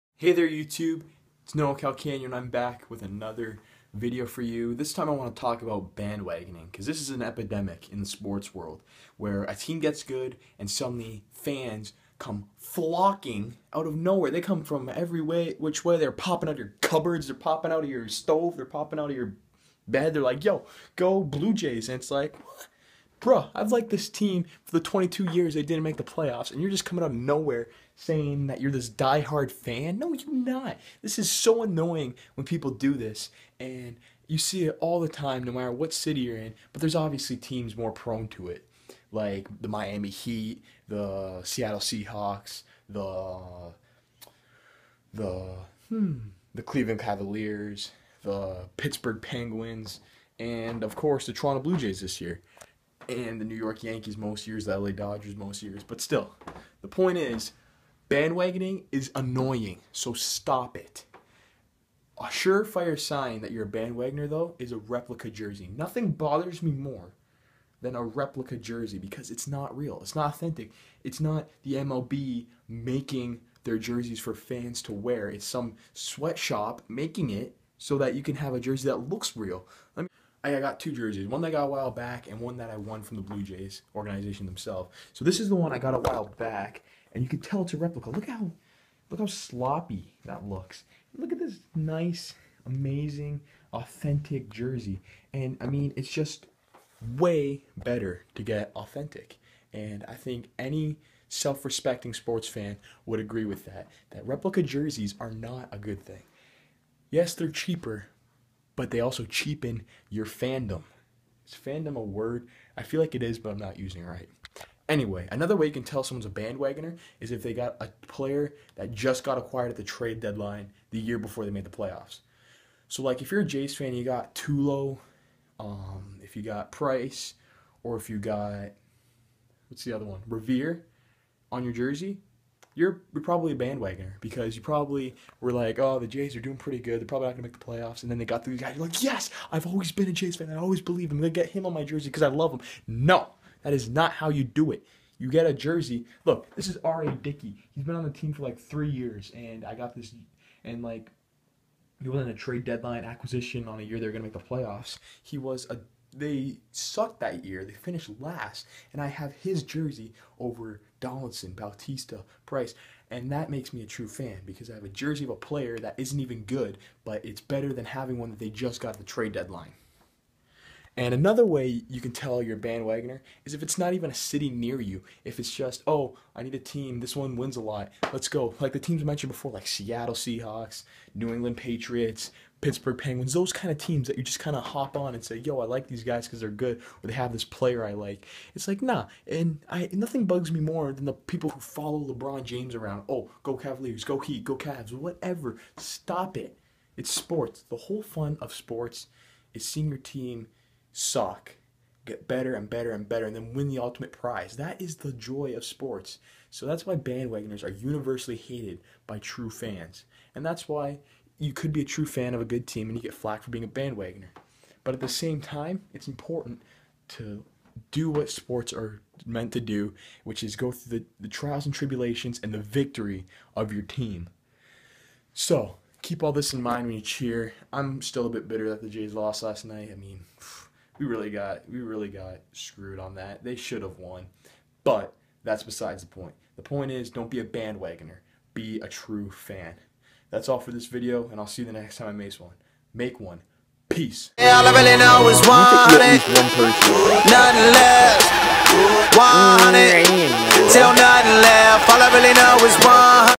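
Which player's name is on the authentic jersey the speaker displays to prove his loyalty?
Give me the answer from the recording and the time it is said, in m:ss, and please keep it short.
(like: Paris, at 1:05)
R.A. Dickey, at 2:26.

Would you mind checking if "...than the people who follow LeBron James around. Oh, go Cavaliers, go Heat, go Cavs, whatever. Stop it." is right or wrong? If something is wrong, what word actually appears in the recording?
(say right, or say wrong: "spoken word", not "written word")
right.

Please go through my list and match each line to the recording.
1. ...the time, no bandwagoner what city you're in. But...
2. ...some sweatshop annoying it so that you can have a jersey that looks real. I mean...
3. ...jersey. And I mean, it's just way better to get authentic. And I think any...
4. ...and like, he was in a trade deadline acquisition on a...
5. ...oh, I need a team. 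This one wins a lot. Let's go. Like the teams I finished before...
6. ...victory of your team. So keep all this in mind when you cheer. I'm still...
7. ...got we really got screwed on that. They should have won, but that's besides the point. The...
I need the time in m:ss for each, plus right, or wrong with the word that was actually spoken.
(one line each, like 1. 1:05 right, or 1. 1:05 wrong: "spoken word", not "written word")
1. 0:34 wrong: "matter", not "bandwagoner"
2. 1:15 wrong: "making", not "annoying"
3. 1:34 right
4. 2:30 right
5. 2:55 wrong: "mentioned", not "finished"
6. 3:42 right
7. 3:51 right.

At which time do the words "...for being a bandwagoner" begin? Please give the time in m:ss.
3:33.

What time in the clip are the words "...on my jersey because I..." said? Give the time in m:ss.
2:21.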